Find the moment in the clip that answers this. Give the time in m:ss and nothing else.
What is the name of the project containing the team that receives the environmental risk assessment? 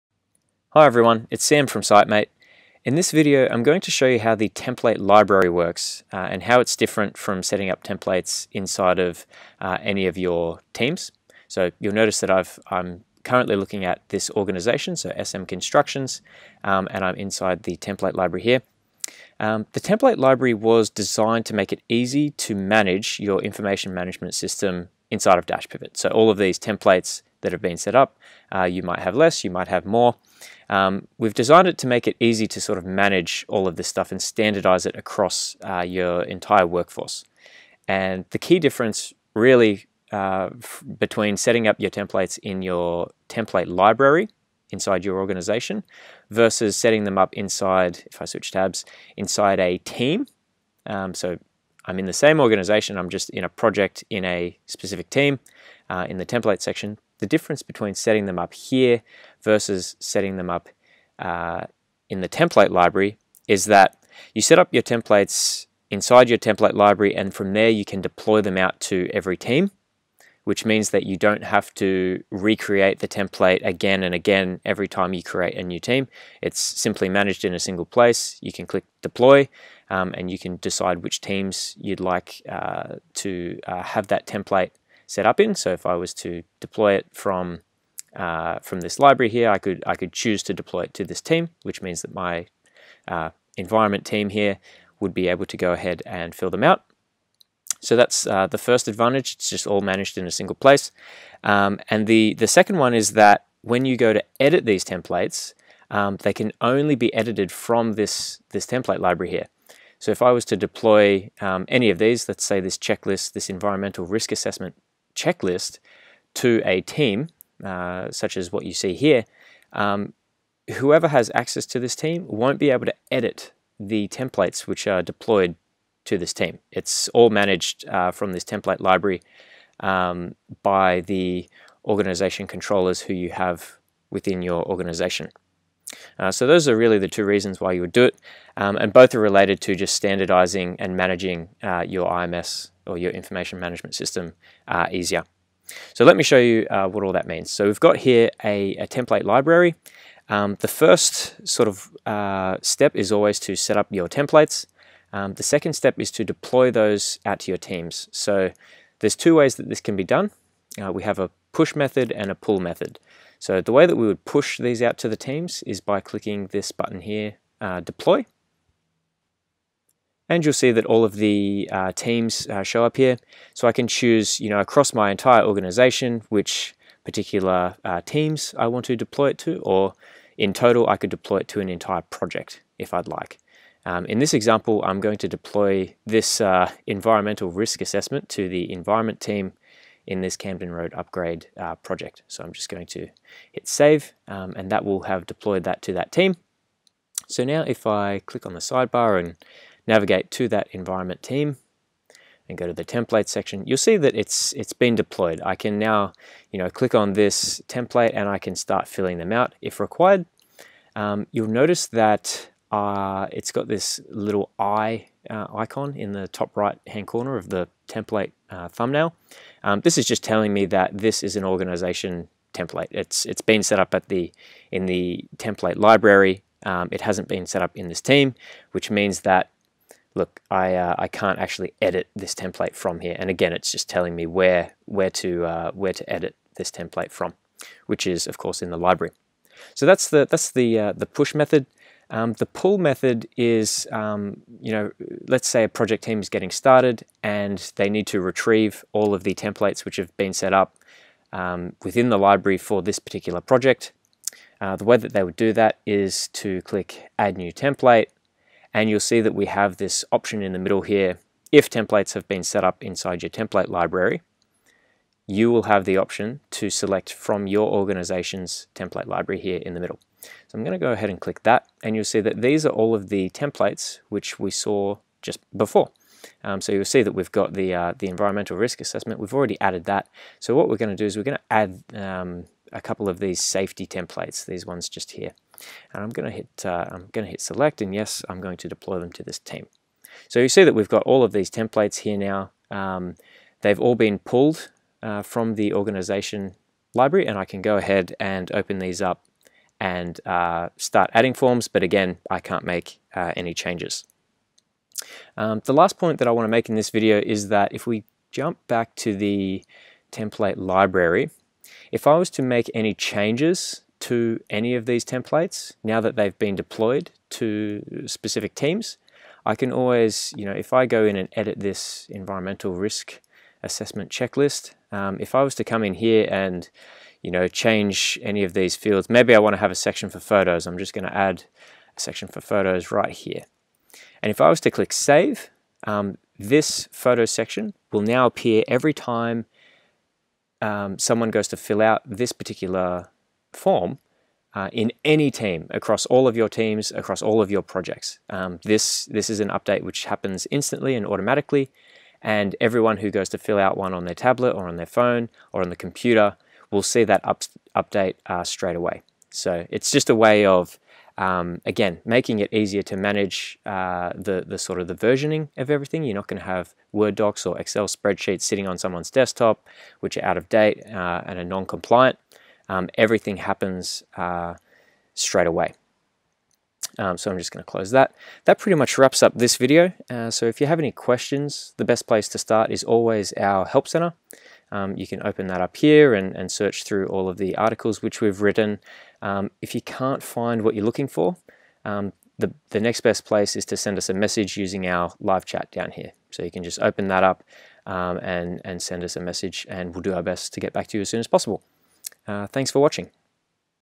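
3:10.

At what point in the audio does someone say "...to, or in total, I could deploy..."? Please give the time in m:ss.
2:59.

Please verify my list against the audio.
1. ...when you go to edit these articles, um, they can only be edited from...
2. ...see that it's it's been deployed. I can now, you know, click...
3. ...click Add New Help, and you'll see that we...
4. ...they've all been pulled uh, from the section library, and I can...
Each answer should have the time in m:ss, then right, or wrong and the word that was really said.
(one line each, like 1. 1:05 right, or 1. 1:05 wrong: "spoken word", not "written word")
1. 1:43 wrong: "templates", not "articles"
2. 3:23 right
3. 4:16 wrong: "Template", not "Help"
4. 4:53 wrong: "organization", not "section".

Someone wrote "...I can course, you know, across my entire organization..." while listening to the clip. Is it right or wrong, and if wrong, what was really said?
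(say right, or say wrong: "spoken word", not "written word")
wrong: "choose", not "course".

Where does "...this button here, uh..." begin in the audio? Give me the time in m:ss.
2:46.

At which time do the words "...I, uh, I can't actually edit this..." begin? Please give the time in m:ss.
3:50.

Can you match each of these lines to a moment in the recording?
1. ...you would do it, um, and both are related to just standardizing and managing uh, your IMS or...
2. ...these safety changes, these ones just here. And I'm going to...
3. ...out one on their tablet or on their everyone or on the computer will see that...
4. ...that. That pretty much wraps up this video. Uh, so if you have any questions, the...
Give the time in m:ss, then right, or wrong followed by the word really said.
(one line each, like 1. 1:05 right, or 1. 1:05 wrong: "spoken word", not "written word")
1. 2:17 right
2. 4:43 wrong: "templates", not "changes"
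3. 5:53 wrong: "phone", not "everyone"
4. 6:17 right.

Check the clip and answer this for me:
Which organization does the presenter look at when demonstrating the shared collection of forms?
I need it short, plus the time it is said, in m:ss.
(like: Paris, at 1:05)
SM Constructions, at 0:15.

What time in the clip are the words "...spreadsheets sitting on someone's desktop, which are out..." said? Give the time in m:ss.
6:07.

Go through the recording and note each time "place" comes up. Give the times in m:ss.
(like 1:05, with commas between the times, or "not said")
1:17, 1:40, 6:22, 6:33.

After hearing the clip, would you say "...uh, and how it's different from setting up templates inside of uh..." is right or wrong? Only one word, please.
right.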